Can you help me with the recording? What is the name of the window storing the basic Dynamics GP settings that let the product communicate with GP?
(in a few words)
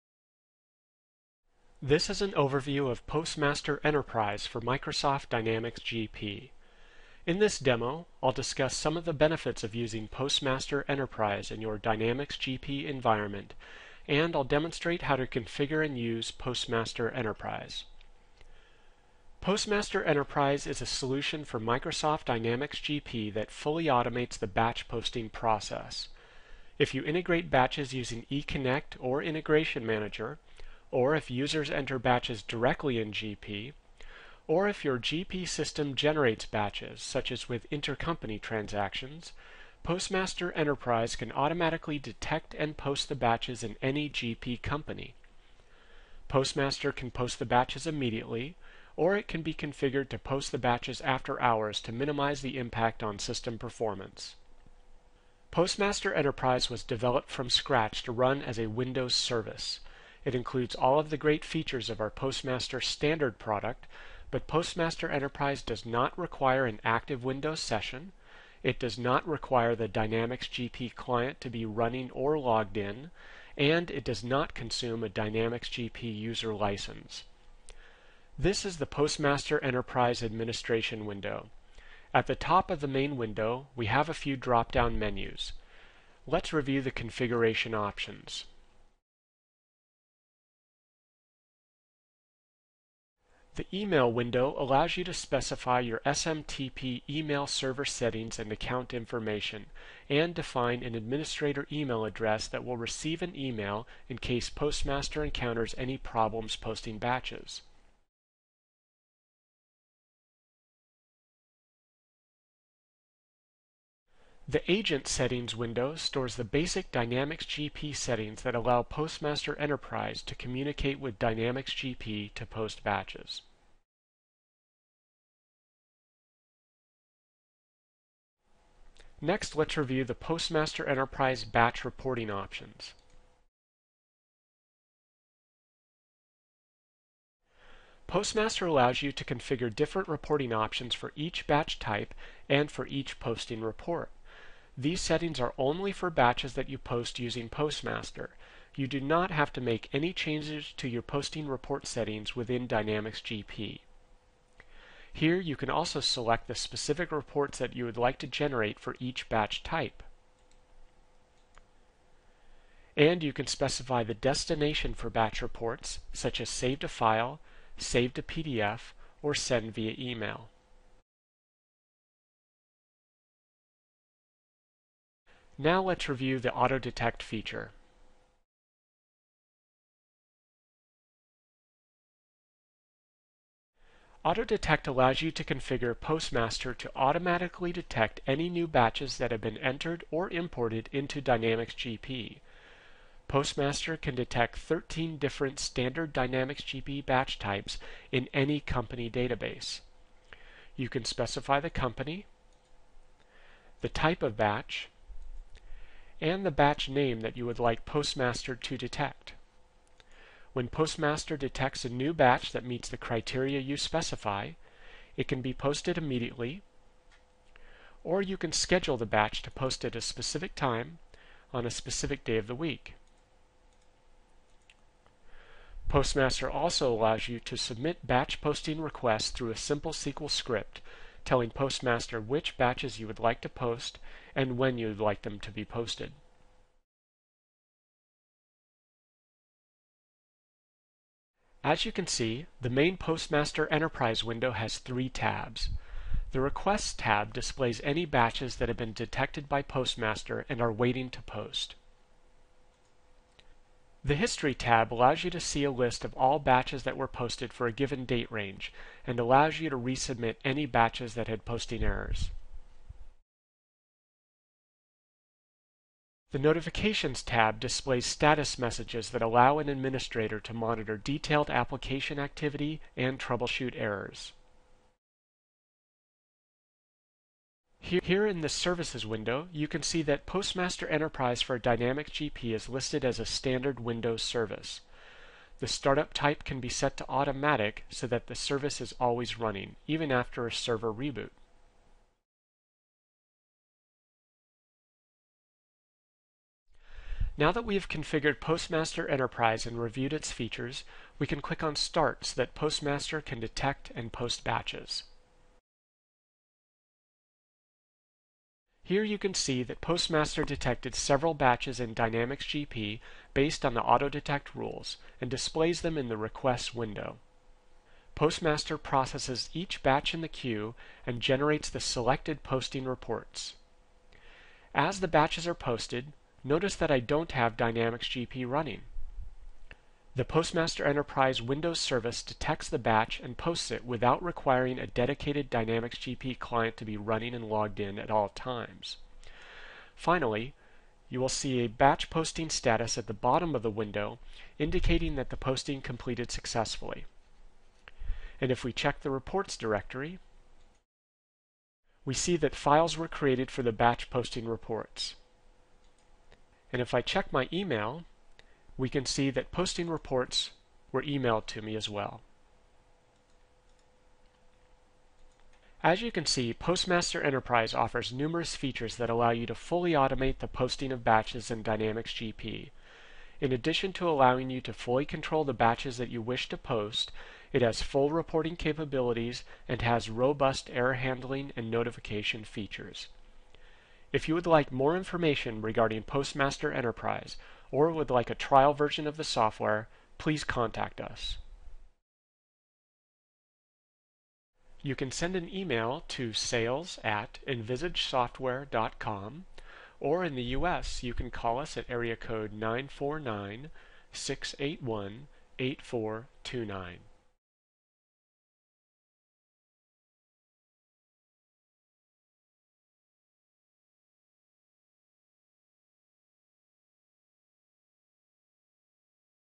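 Agent Settings.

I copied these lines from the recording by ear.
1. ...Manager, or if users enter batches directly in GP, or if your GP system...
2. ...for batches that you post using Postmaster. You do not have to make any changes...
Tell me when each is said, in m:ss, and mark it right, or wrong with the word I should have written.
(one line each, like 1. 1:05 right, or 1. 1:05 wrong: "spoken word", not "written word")
1. 0:29 right
2. 2:25 right.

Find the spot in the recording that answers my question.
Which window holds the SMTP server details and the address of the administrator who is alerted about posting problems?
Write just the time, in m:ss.
1:33.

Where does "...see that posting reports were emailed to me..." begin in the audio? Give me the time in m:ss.
5:59.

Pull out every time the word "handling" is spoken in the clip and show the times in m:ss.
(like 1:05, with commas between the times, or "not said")
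6:20.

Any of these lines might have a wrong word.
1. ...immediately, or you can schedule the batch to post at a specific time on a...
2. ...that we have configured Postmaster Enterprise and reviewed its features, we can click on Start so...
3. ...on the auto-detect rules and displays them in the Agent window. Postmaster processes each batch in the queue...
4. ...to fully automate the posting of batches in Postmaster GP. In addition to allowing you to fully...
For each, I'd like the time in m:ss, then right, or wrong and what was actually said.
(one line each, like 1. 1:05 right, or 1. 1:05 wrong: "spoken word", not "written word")
1. 3:35 right
2. 4:57 right
3. 5:13 wrong: "Requests", not "Agent"
4. 6:09 wrong: "Dynamics", not "Postmaster".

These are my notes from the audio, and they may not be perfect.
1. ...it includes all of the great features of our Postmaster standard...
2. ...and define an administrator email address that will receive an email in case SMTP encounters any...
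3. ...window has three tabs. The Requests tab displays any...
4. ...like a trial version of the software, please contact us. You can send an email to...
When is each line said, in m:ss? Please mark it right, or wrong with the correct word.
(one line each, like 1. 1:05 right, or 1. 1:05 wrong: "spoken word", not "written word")
1. 1:00 right
2. 1:40 wrong: "Postmaster", not "SMTP"
3. 4:04 right
4. 6:28 right.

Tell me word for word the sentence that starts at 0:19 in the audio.
Postmaster Enterprise is a solution for Microsoft Dynamics GP that fully automates the batch posting process.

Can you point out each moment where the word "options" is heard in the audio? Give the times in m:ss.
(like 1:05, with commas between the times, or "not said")
1:27, 2:12, 2:20.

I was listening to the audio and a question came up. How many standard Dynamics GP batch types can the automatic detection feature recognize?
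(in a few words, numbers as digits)
13.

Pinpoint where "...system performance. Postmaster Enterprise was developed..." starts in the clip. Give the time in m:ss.
0:53.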